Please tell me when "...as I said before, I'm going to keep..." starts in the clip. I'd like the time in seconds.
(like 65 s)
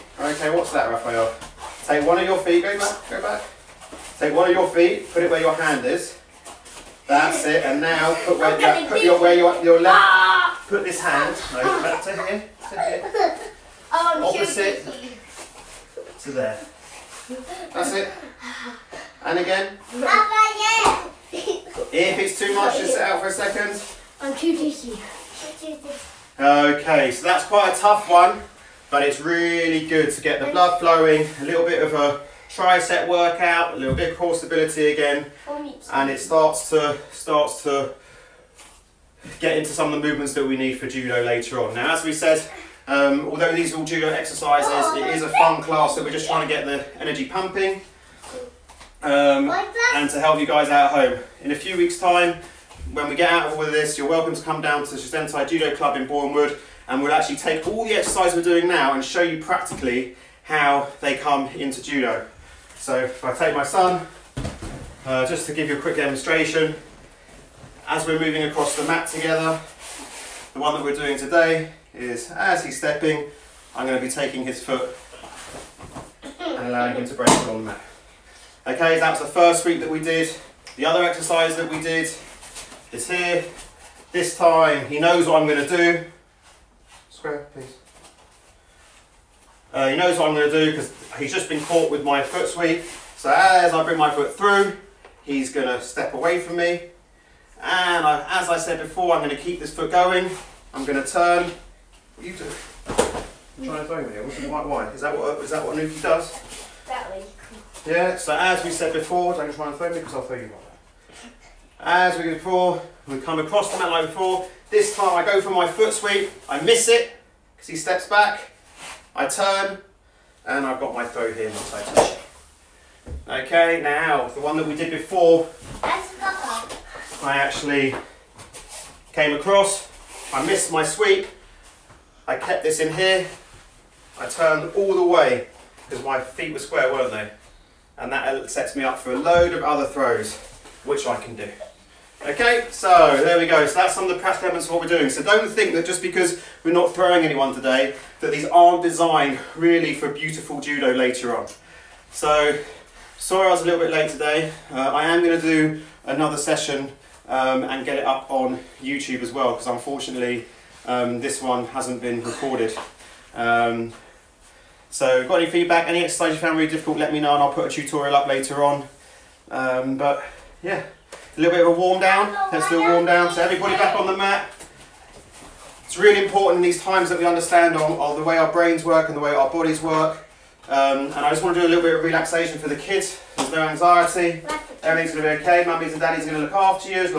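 98 s.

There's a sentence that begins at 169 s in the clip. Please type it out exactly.
Um, but yeah, a little bit of a warm down.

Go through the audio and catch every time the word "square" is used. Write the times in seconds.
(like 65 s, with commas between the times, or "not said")
87 s, 136 s.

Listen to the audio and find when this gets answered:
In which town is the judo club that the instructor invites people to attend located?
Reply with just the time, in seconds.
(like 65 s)
56 s.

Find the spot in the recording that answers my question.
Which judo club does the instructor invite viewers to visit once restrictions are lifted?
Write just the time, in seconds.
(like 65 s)
54 s.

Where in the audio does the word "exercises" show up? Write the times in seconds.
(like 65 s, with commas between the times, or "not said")
44 s, 57 s, 81 s, 166 s.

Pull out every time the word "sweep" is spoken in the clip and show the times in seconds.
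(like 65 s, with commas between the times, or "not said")
79 s, 92 s, 115 s, 130 s.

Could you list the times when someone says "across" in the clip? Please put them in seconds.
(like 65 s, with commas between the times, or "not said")
68 s, 113 s, 129 s.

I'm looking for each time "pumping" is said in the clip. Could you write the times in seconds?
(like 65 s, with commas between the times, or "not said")
47 s.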